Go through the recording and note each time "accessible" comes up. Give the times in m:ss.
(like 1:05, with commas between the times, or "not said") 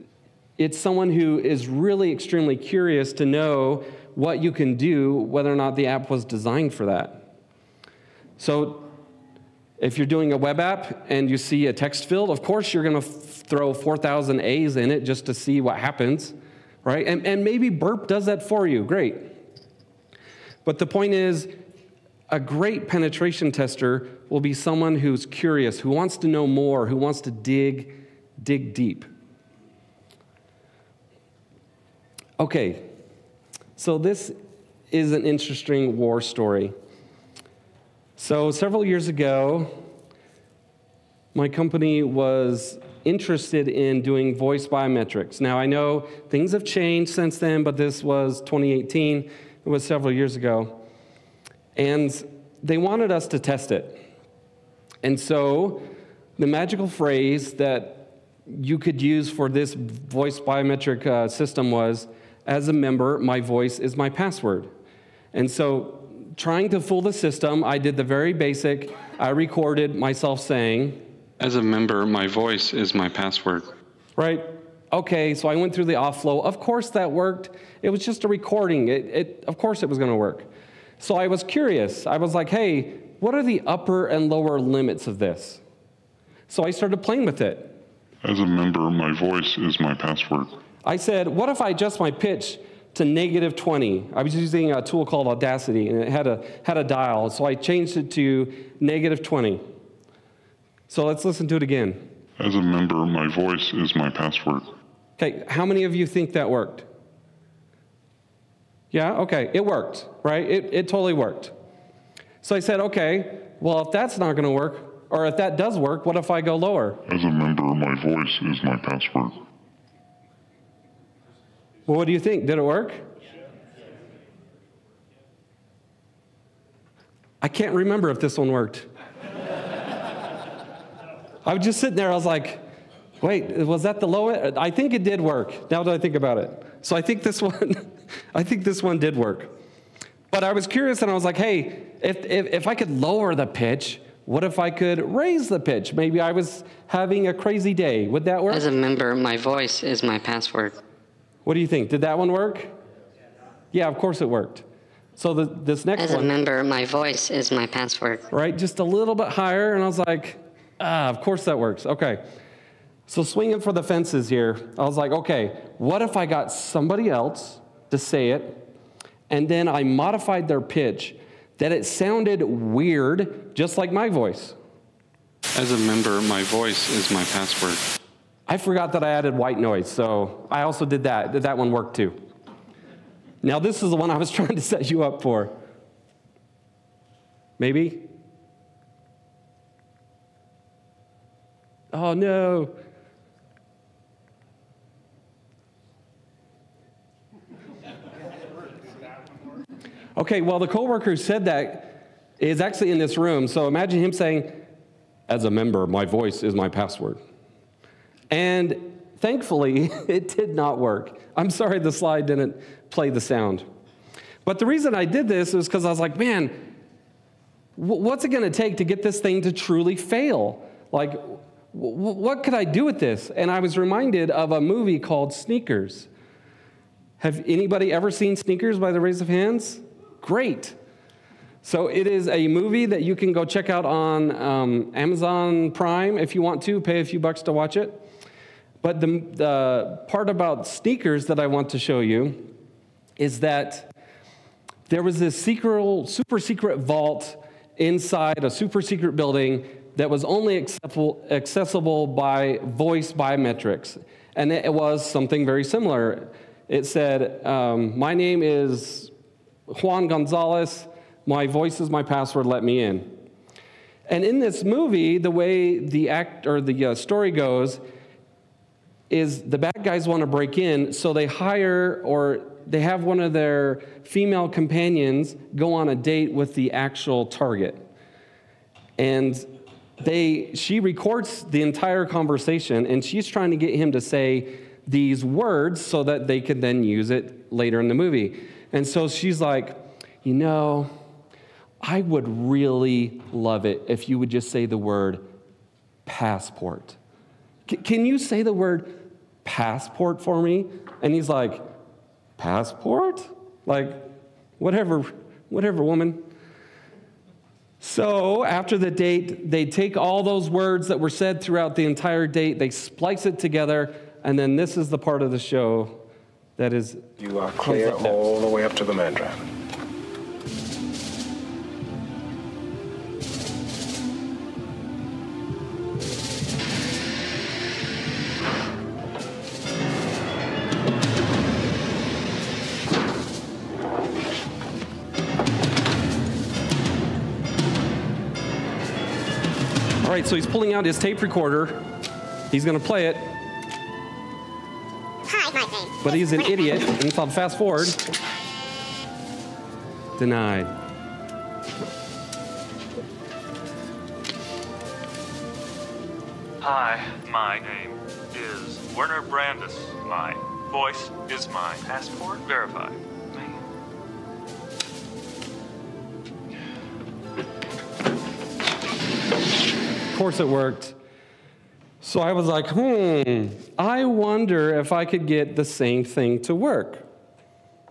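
4:11.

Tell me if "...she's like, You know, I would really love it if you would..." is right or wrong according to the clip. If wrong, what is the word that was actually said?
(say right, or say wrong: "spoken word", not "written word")
right.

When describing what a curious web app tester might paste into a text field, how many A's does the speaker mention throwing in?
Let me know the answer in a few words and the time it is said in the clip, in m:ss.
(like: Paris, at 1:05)
4,000, at 0:13.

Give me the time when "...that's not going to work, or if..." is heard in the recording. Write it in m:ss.
1:53.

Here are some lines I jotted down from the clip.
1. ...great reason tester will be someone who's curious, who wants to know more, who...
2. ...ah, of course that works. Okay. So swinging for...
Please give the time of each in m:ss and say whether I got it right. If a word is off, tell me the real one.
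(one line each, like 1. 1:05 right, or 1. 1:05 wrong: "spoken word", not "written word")
1. 0:22 wrong: "penetration", not "reason"
2. 2:40 right.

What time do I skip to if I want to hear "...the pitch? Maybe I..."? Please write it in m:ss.
2:25.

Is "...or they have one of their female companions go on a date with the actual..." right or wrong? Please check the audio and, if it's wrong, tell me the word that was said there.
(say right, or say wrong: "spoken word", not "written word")
right.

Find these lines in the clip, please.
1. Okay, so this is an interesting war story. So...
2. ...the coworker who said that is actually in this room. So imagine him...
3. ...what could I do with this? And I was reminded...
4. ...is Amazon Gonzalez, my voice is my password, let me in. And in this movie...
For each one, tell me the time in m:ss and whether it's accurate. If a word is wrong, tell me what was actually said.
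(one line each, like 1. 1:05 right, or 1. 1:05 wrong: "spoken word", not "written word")
1. 0:32 right
2. 3:20 right
3. 3:41 right
4. 4:18 wrong: "Juan", not "Amazon".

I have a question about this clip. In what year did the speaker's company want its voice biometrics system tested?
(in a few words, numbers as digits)
2018.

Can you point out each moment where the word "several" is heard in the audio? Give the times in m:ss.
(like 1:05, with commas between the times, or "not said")
0:38, 0:49.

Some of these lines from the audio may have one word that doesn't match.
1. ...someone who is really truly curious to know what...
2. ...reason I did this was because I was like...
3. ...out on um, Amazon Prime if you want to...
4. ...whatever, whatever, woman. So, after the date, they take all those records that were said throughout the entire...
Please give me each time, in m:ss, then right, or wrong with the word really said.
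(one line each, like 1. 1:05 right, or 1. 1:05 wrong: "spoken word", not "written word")
1. 0:00 wrong: "extremely", not "truly"
2. 3:34 right
3. 3:53 right
4. 5:04 wrong: "words", not "records".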